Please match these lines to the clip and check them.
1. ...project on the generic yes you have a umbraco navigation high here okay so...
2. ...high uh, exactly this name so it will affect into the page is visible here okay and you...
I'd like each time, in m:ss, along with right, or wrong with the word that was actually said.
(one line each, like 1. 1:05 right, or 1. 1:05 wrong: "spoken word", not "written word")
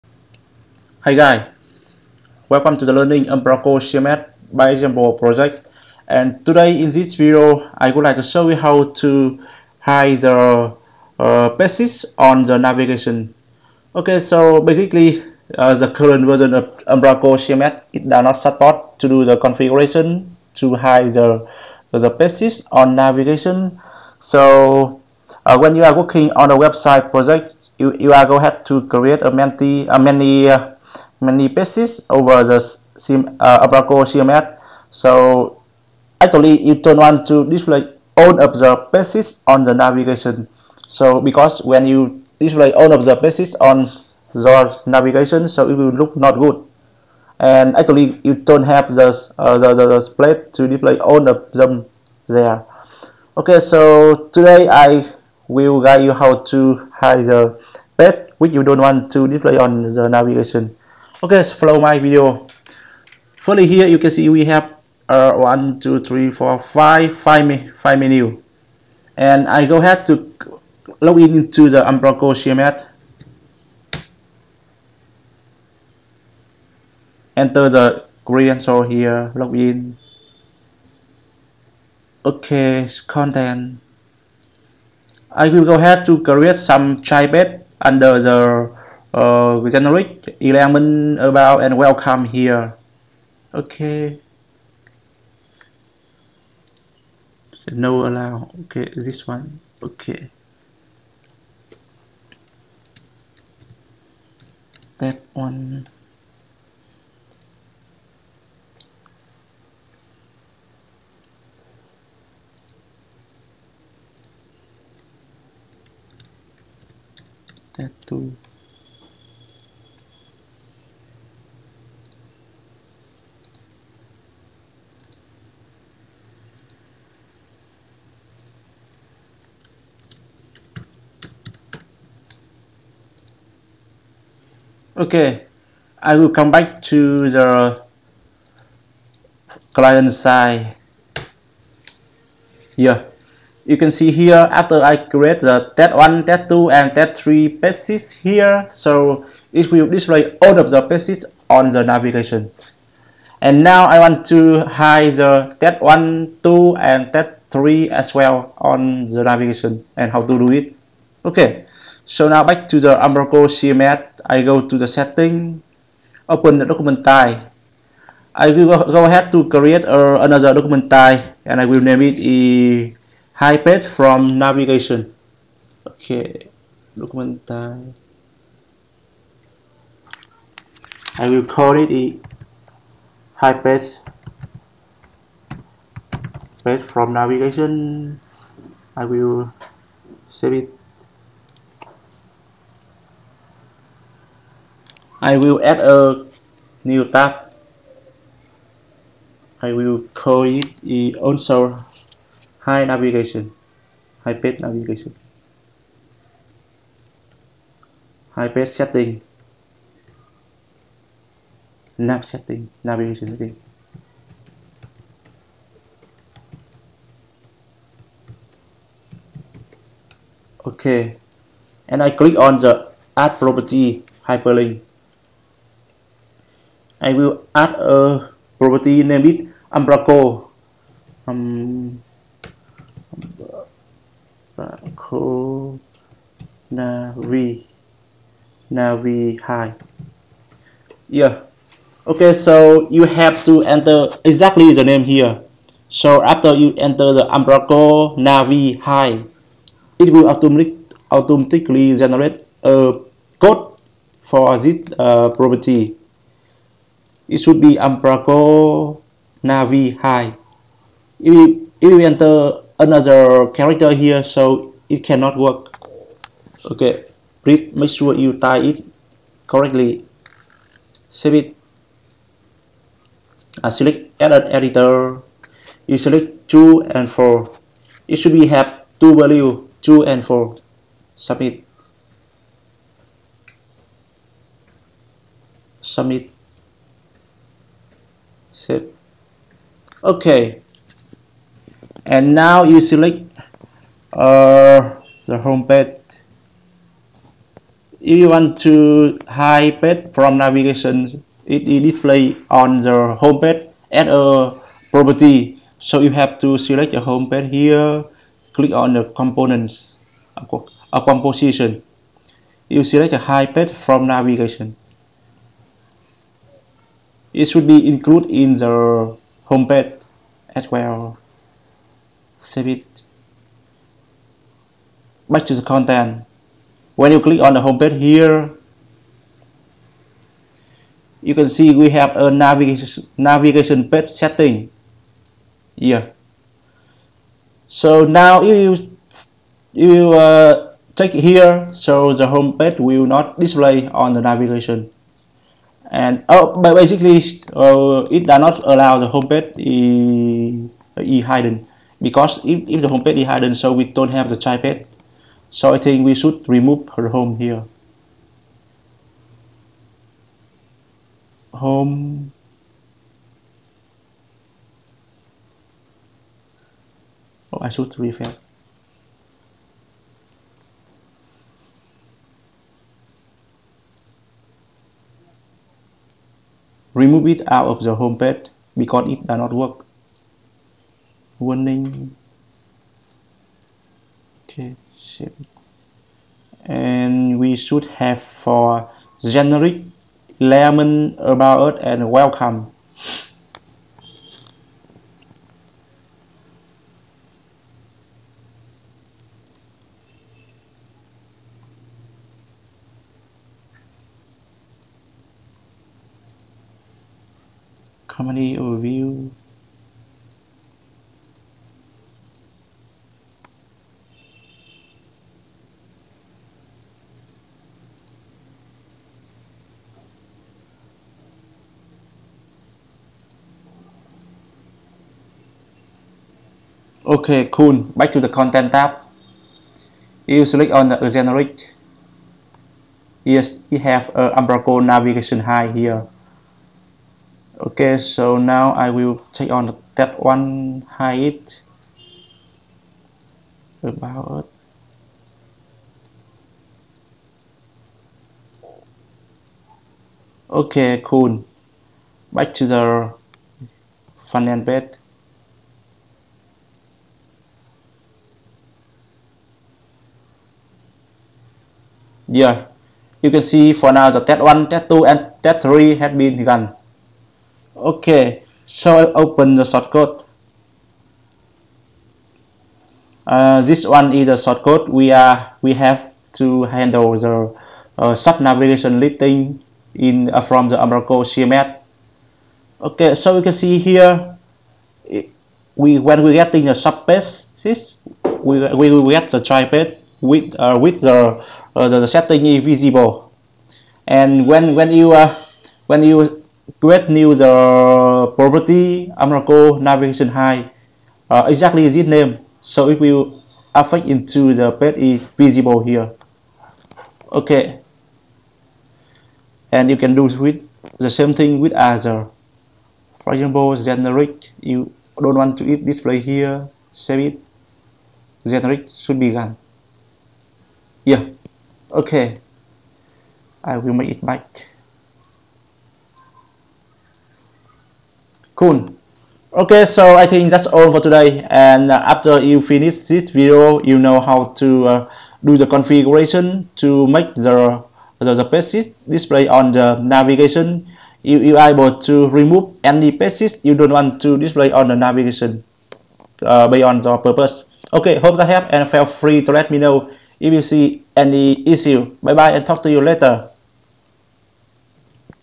1. 7:10 wrong: "select", not "project"
2. 8:20 right.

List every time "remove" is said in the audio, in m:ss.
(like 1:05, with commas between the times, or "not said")
5:56, 6:17, 9:02.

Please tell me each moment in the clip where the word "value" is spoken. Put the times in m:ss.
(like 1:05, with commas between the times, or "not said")
4:39.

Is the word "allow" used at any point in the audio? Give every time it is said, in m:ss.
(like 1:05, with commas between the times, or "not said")
1:38, 5:48.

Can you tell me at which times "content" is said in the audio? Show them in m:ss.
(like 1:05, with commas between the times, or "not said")
1:23, 5:25, 7:08.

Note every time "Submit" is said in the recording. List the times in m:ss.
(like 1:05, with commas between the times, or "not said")
4:41, 4:45.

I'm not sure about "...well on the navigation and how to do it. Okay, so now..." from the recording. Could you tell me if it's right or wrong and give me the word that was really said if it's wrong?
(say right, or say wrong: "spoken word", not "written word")
right.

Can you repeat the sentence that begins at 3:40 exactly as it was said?
Okay, and I click on the add property hyperlink.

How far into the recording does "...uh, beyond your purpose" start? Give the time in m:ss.
9:06.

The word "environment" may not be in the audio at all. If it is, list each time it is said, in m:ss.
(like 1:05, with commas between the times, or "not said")
not said.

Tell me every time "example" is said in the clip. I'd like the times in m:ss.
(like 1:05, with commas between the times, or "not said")
0:04, 8:33.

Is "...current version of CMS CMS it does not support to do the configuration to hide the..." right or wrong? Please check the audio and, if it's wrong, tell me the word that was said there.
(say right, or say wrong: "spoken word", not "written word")
wrong: "Umbraco", not "CMS".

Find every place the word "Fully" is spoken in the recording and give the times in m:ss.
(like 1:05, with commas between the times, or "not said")
1:03.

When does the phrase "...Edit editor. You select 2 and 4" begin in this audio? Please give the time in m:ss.
4:34.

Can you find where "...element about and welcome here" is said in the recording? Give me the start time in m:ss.
1:30.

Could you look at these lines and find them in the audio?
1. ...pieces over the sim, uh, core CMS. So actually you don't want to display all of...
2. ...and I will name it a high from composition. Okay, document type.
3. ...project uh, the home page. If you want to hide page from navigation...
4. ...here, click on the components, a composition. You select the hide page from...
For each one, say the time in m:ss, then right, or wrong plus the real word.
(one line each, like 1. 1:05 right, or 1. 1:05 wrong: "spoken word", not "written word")
1. 0:31 right
2. 2:51 wrong: "navigation", not "composition"
3. 4:52 wrong: "select", not "project"
4. 5:07 right.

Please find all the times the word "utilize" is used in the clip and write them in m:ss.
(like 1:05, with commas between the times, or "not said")
not said.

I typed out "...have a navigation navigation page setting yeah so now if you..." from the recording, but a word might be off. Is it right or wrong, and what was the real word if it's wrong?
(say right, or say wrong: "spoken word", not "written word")
right.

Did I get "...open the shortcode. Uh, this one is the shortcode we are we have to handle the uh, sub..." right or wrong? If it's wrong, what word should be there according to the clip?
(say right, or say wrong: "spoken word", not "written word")
right.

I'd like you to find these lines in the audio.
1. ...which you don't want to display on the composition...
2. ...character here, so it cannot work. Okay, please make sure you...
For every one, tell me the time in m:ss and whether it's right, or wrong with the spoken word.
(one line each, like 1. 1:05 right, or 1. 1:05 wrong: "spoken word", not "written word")
1. 0:58 wrong: "navigation", not "composition"
2. 4:23 right.